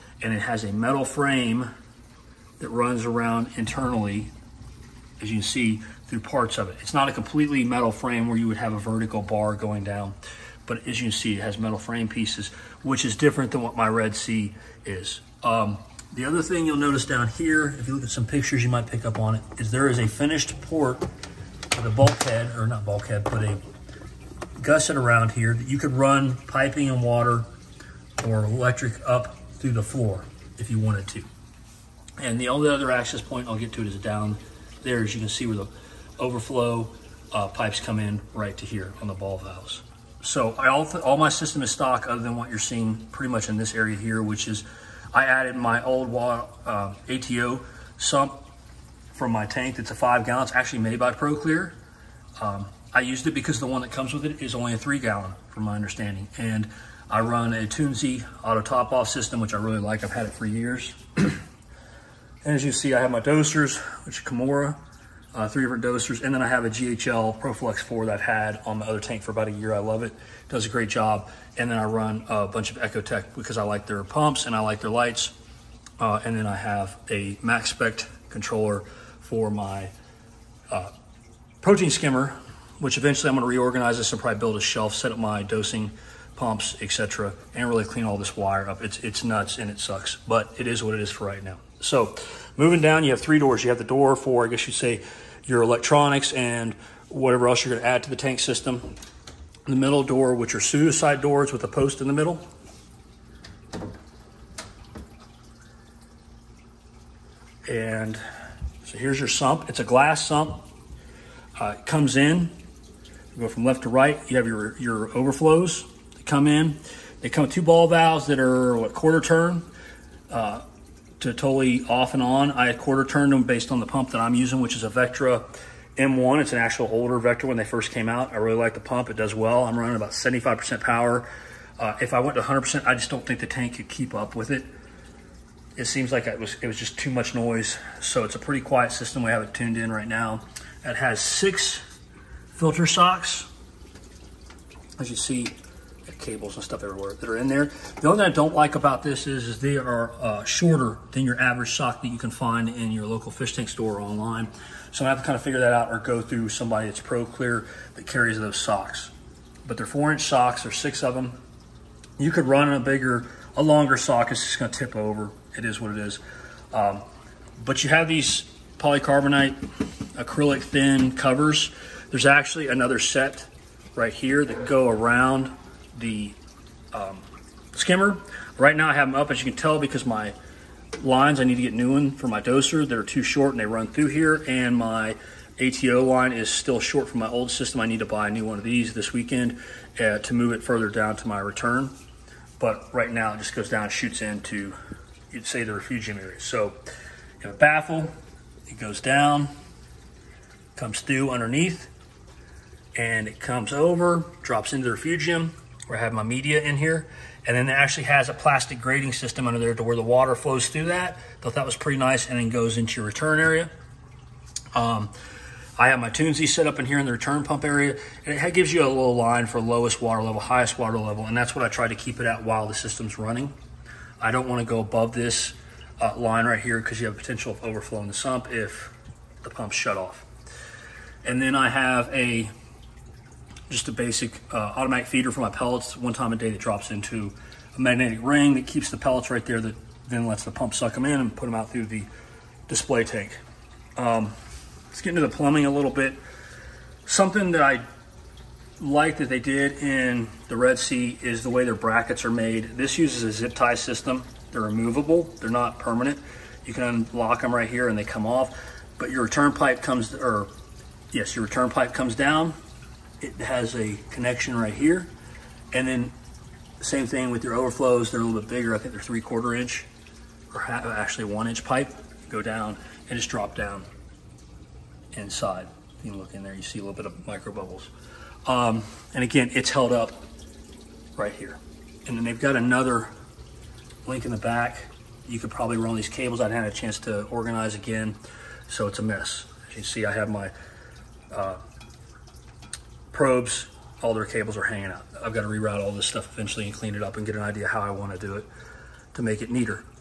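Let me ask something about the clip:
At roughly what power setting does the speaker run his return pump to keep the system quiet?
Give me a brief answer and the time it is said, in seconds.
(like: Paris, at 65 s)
75%, at 130 s.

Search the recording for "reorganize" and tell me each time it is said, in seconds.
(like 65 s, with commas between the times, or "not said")
83 s.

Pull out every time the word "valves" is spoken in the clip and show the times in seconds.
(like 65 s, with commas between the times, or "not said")
39 s, 117 s.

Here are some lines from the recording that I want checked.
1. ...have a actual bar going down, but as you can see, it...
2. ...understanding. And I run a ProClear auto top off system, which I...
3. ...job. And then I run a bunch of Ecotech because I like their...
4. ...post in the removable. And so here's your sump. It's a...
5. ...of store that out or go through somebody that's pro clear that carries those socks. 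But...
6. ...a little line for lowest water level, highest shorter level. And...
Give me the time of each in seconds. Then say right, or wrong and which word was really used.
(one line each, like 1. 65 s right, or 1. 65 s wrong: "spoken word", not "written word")
1. 8 s wrong: "vertical", not "actual"
2. 55 s wrong: "Toonsy", not "ProClear"
3. 70 s right
4. 101 s wrong: "middle", not "removable"
5. 155 s wrong: "figure", not "store"
6. 218 s wrong: "water", not "shorter".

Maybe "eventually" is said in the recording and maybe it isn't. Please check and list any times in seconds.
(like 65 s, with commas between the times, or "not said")
82 s, 296 s.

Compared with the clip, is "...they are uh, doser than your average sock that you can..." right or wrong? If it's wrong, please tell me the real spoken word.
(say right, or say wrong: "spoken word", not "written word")
wrong: "shorter", not "doser".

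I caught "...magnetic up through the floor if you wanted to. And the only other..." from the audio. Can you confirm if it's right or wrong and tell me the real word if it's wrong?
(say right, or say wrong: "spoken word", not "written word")
wrong: "electric", not "magnetic".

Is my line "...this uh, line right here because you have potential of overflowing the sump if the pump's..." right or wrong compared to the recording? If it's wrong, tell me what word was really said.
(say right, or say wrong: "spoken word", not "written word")
right.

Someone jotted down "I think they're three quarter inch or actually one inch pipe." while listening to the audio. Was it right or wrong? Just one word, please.
right.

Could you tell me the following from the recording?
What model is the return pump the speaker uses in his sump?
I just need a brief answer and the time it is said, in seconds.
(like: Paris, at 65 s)
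Vectra M1, at 124 s.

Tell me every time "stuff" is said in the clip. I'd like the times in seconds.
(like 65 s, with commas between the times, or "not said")
146 s, 296 s.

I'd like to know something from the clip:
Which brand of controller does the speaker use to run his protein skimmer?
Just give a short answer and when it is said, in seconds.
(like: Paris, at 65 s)
Maxspect, at 77 s.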